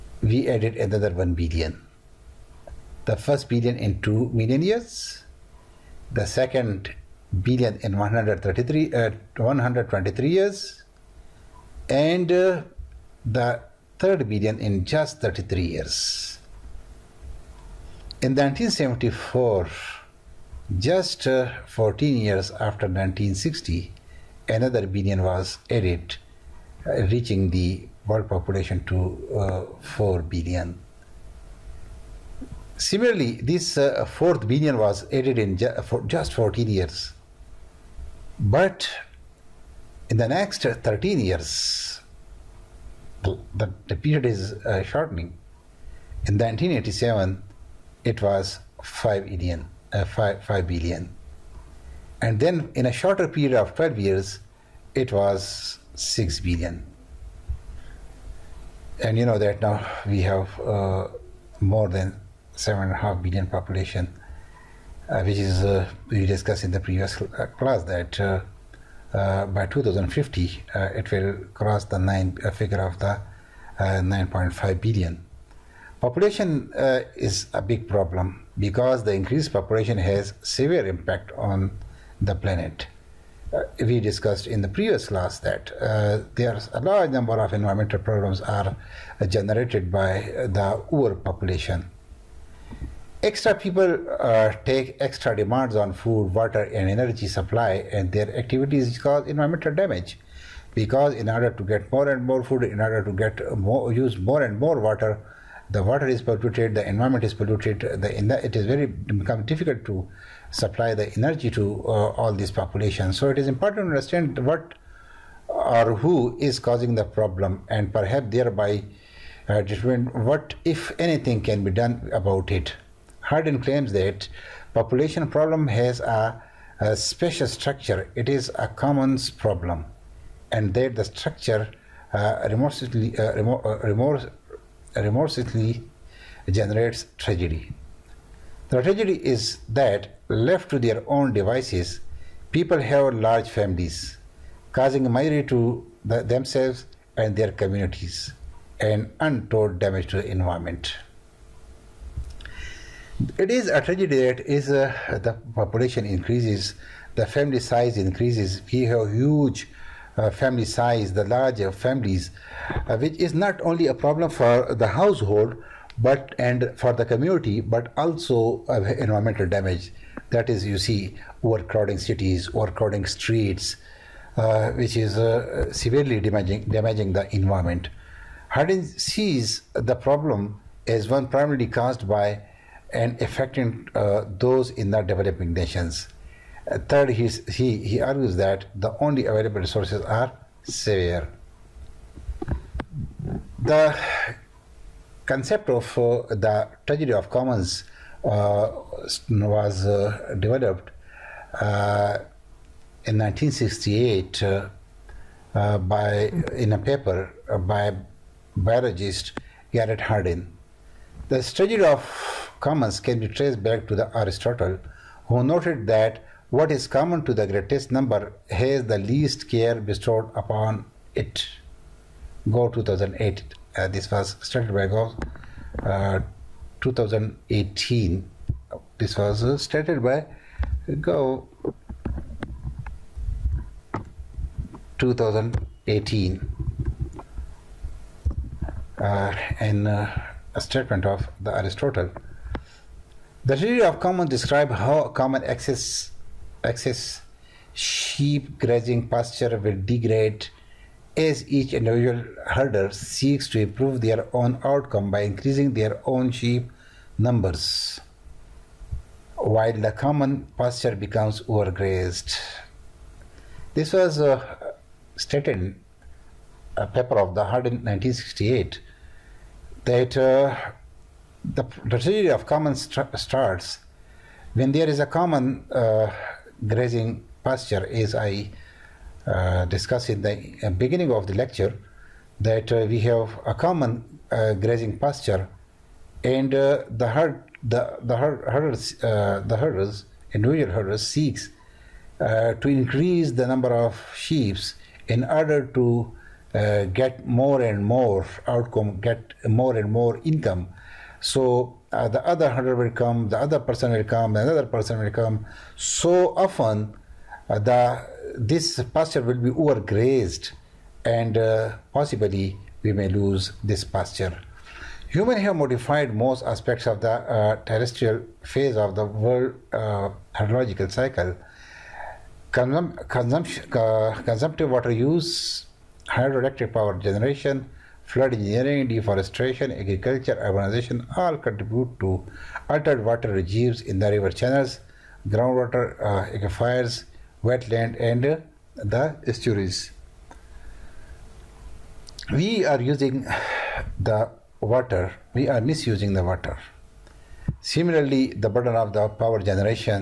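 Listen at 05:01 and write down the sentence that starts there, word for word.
So uh, the other hundred will come, the other person will come, another person will come.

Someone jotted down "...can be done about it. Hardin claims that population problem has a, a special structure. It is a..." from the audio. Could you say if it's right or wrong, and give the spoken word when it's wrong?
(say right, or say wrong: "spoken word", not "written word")
right.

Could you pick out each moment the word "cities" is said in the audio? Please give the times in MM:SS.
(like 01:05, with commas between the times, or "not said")
02:51.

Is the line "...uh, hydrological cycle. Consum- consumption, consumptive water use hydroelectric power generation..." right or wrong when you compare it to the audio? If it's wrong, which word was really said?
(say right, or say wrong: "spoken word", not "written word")
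right.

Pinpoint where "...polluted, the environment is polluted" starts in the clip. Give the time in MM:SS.
01:46.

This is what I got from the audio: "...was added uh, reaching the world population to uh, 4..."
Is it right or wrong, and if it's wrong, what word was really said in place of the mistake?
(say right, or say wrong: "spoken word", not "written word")
right.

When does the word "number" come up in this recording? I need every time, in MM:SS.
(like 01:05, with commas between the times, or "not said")
01:27, 03:37, 04:17, 04:53.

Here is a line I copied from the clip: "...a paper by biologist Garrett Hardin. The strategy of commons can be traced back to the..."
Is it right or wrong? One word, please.
right.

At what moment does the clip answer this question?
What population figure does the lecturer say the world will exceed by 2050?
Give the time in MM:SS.
01:13.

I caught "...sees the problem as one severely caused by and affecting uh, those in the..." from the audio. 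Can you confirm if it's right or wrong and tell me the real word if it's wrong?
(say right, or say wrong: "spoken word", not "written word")
wrong: "primarily", not "severely".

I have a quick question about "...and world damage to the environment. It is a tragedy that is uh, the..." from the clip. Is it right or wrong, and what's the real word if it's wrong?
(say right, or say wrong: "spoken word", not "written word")
wrong: "untold", not "world".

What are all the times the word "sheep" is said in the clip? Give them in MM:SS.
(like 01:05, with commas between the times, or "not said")
04:07, 04:16, 04:54.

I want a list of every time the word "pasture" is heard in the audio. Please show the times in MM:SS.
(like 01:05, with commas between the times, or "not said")
04:09, 04:20, 04:37, 04:44, 05:08, 05:13.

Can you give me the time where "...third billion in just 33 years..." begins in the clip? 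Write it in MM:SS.
00:13.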